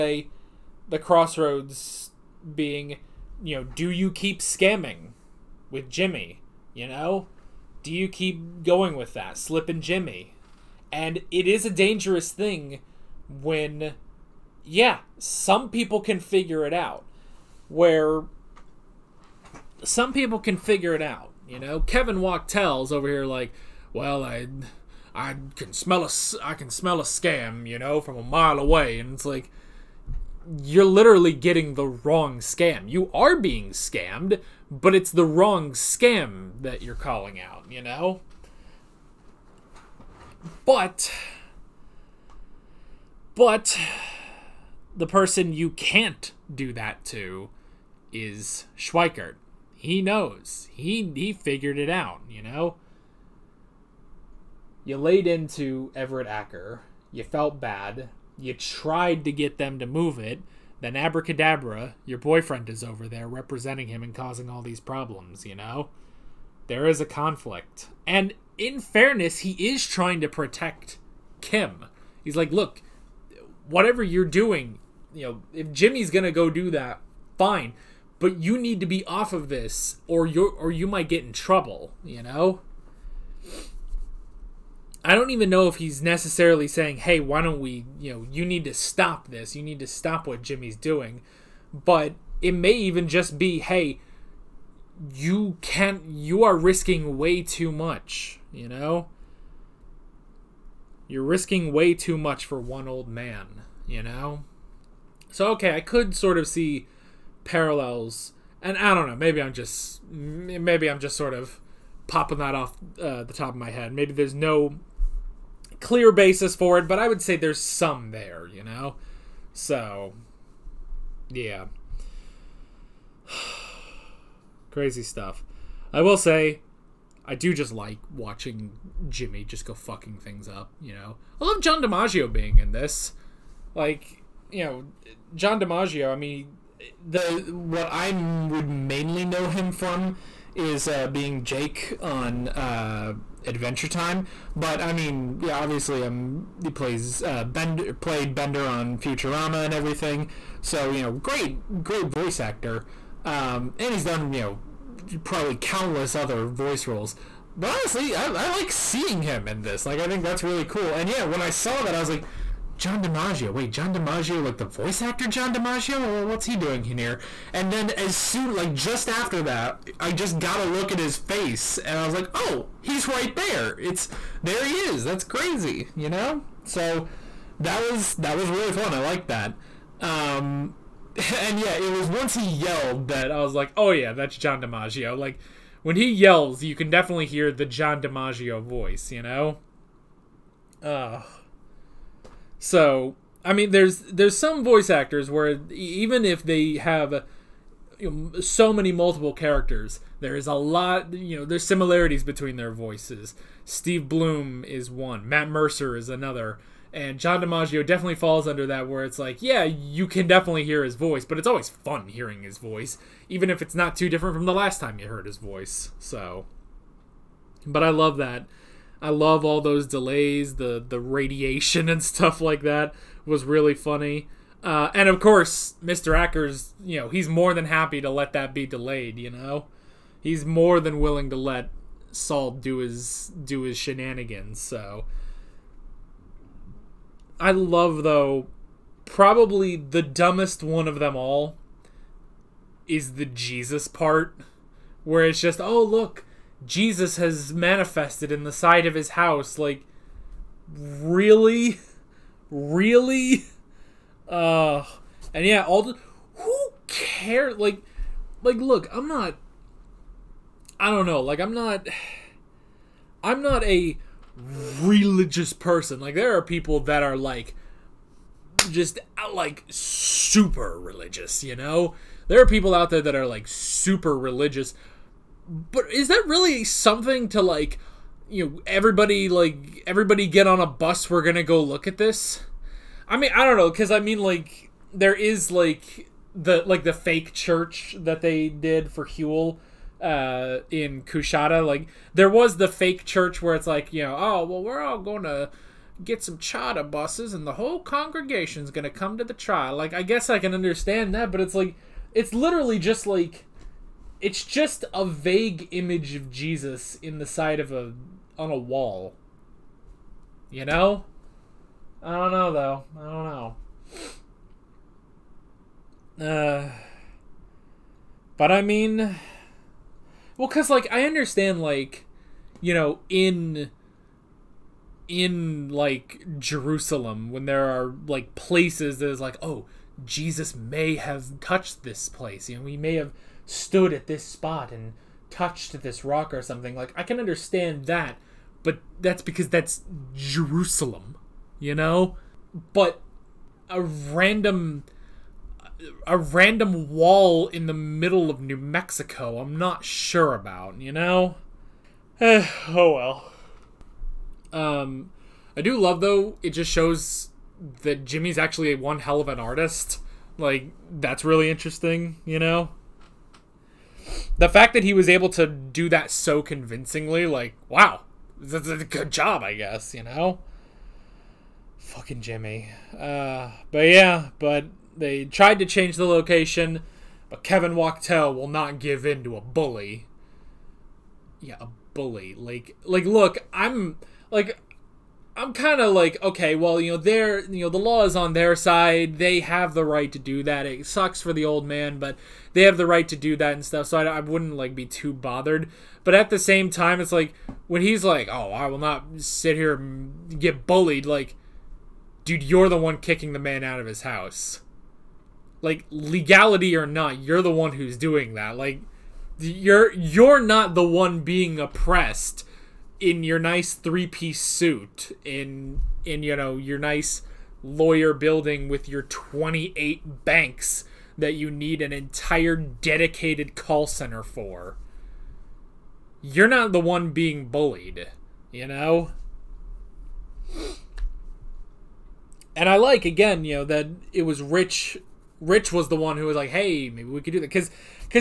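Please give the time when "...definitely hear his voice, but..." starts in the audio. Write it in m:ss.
3:30.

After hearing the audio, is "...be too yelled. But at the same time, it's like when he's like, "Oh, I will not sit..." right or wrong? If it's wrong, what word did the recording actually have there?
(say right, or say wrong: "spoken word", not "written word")
wrong: "bothered", not "yelled".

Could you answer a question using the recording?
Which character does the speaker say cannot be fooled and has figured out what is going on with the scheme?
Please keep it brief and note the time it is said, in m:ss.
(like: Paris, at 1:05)
Schweikert, at 0:48.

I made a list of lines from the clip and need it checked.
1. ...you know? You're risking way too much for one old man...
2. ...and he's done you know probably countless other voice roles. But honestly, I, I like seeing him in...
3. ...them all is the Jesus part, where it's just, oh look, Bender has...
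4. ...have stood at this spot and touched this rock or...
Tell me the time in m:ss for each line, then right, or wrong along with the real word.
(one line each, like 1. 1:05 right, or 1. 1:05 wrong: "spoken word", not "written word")
1. 1:38 right
2. 2:33 right
3. 4:00 wrong: "Jesus", not "Bender"
4. 5:32 right.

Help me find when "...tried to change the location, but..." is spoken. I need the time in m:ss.
6:15.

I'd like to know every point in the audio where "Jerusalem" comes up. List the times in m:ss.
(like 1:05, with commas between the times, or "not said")
5:26, 5:40.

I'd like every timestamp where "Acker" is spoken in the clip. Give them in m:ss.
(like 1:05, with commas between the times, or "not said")
0:56, 3:46.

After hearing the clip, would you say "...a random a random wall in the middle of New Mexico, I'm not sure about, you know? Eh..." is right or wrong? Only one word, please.
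right.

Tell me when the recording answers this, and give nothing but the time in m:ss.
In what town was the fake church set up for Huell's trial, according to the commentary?
4:51.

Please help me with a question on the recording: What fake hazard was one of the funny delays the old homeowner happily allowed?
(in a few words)
radiation.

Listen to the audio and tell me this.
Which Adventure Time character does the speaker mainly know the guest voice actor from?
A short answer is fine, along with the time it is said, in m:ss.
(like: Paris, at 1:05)
Jake, at 2:21.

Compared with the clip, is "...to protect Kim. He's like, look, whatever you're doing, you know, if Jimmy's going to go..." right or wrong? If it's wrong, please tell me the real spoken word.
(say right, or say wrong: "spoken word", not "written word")
right.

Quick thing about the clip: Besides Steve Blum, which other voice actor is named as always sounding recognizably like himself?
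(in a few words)
Matt Mercer.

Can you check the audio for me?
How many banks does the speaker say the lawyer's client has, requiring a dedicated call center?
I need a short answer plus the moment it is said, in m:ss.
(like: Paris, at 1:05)
28, at 6:59.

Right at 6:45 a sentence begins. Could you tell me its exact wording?
Like legality or not, you're the one who's doing that.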